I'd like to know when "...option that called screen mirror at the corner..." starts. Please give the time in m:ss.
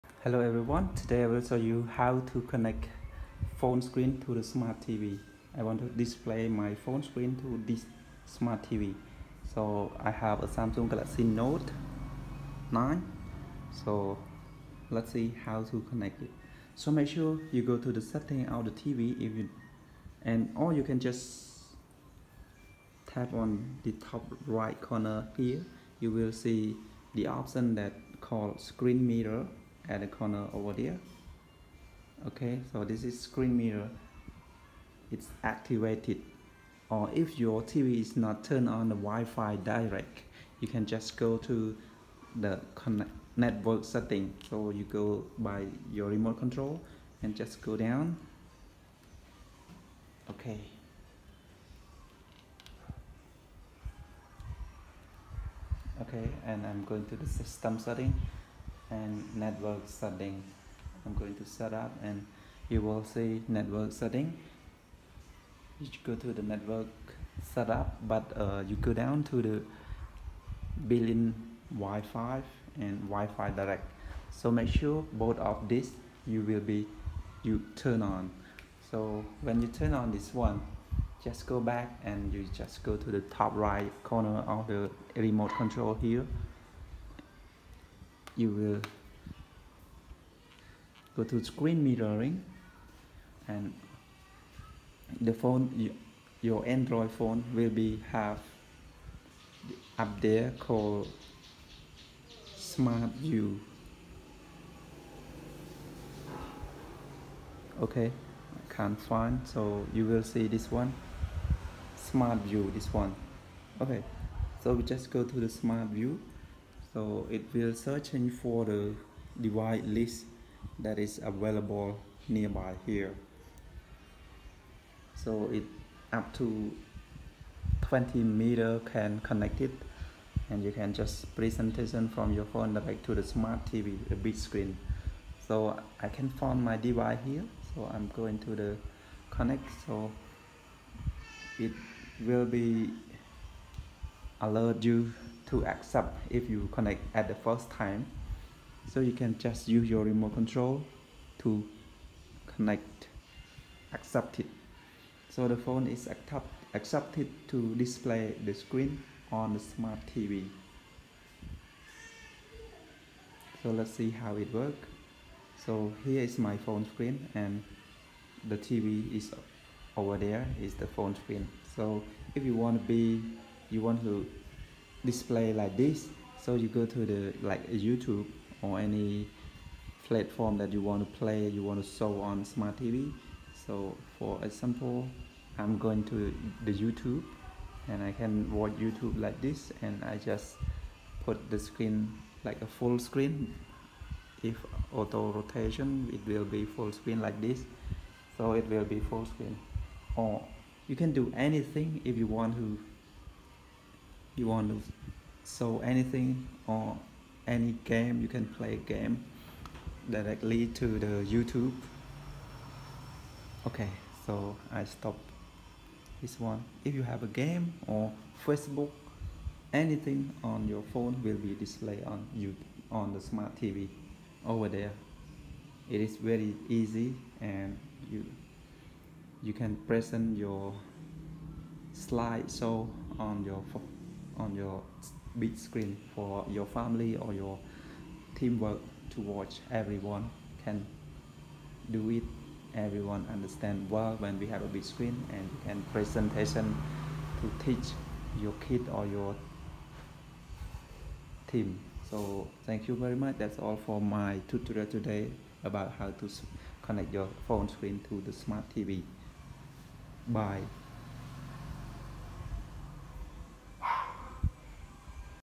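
0:27.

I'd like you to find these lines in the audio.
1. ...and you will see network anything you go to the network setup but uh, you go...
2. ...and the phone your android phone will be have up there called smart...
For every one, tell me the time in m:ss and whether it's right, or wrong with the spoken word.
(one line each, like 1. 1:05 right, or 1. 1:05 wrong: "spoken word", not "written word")
1. 1:02 wrong: "setting", not "anything"
2. 1:33 right.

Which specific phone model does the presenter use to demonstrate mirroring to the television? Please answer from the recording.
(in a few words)
Samsung Galaxy Note 9.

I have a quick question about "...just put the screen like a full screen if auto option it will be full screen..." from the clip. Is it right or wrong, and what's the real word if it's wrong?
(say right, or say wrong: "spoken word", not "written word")
wrong: "rotation", not "option".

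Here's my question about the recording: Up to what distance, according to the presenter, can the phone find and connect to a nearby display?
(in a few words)
20 meters.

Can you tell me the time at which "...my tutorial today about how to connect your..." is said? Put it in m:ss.
4:13.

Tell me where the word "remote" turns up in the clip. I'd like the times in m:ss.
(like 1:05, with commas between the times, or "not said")
0:46, 1:25, 2:30.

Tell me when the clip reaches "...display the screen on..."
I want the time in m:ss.
2:37.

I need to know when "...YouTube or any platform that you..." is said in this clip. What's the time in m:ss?
2:57.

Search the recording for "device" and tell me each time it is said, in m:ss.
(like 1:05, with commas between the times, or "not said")
1:59, 2:16.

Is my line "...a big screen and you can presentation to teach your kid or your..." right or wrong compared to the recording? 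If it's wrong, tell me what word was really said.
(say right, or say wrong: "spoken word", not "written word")
right.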